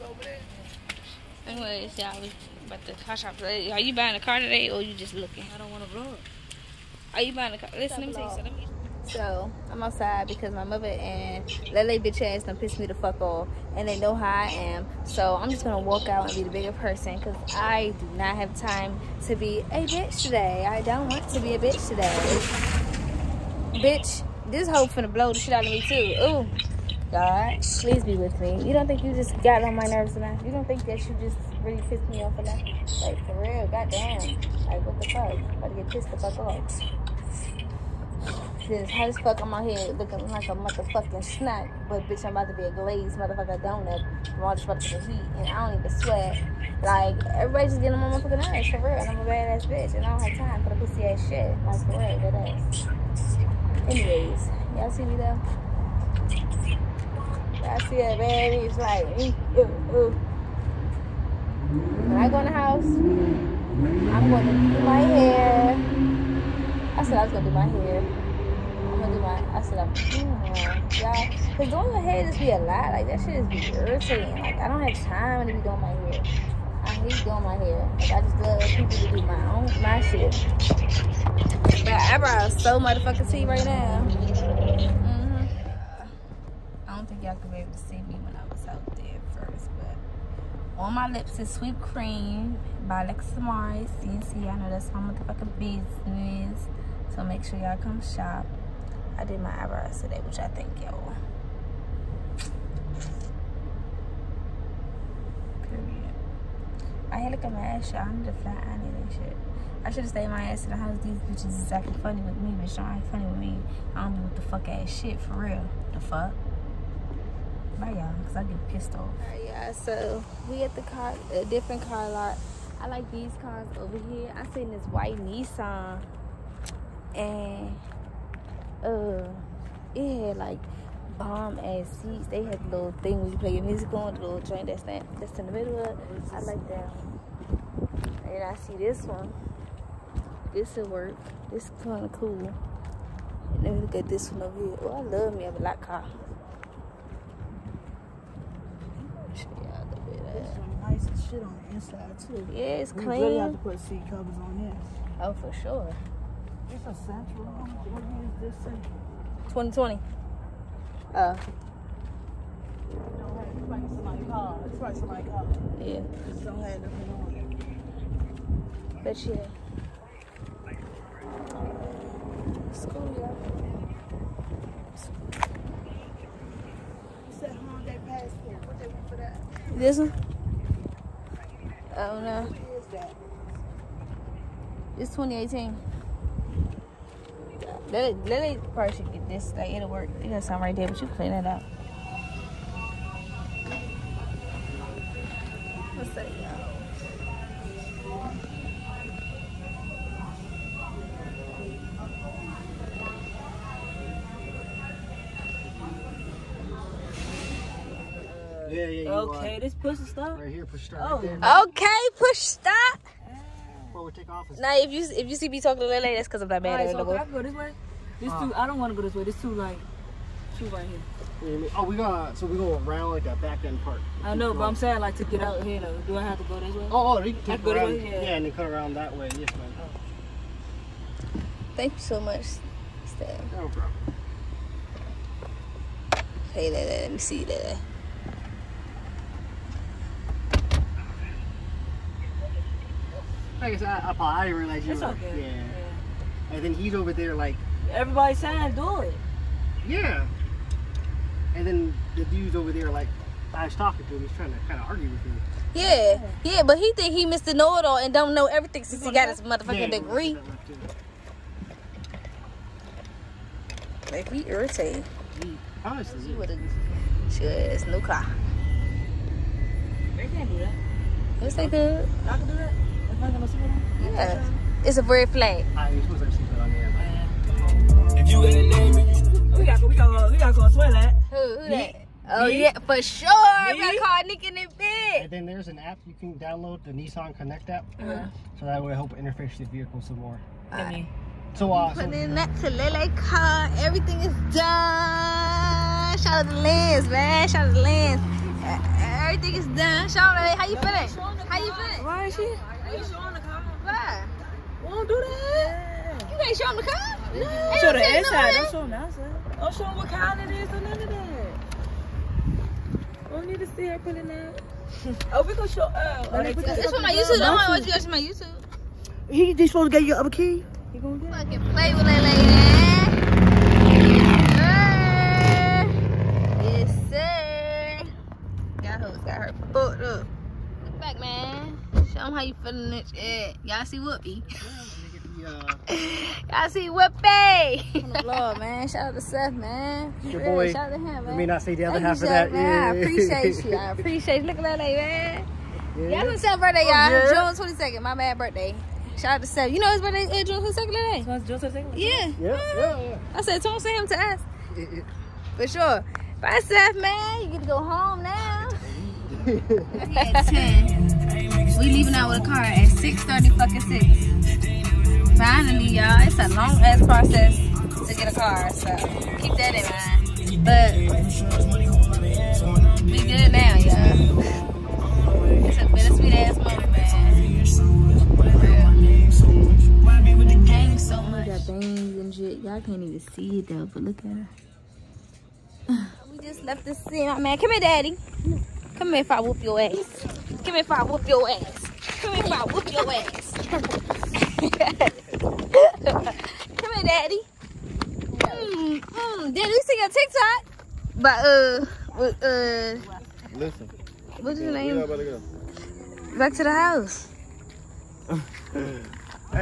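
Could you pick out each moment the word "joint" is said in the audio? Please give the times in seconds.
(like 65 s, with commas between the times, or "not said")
134 s.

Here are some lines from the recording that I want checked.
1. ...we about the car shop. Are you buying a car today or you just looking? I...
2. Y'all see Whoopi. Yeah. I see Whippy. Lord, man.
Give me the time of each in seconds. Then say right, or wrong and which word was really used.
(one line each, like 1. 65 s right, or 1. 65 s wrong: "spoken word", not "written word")
1. 2 s right
2. 333 s right.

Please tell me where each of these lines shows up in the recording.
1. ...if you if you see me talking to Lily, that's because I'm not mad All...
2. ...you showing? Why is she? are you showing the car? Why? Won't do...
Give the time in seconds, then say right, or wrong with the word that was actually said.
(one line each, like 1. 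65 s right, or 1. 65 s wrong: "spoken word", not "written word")
1. 214 s right
2. 301 s wrong: "feeling", not "showing".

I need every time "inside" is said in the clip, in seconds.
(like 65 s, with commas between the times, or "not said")
151 s, 308 s.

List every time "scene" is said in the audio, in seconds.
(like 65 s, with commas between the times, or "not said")
386 s.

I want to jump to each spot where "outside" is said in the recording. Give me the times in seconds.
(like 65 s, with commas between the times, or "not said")
9 s, 308 s.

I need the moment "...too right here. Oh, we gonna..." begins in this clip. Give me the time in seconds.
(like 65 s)
220 s.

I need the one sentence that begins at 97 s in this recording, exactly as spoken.
So make sure y'all come shop.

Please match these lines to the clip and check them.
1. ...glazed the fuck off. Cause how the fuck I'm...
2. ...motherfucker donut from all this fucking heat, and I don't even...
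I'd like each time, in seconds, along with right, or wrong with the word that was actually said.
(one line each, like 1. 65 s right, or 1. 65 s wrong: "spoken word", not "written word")
1. 35 s wrong: "pissed", not "glazed"
2. 43 s right.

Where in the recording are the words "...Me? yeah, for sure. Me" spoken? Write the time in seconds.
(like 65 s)
282 s.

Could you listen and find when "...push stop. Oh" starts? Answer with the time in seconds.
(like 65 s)
210 s.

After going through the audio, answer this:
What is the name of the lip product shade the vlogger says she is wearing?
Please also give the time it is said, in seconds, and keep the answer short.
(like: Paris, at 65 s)
Sweet Cream, at 91 s.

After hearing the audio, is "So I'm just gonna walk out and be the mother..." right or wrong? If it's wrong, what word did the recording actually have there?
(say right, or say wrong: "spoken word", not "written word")
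wrong: "bigger", not "mother".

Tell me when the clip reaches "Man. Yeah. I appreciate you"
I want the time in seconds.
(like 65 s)
342 s.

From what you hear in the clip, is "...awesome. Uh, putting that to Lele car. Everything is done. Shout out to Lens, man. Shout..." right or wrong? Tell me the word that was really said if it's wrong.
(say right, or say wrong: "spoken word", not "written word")
right.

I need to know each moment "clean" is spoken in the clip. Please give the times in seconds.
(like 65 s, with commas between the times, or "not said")
152 s, 191 s.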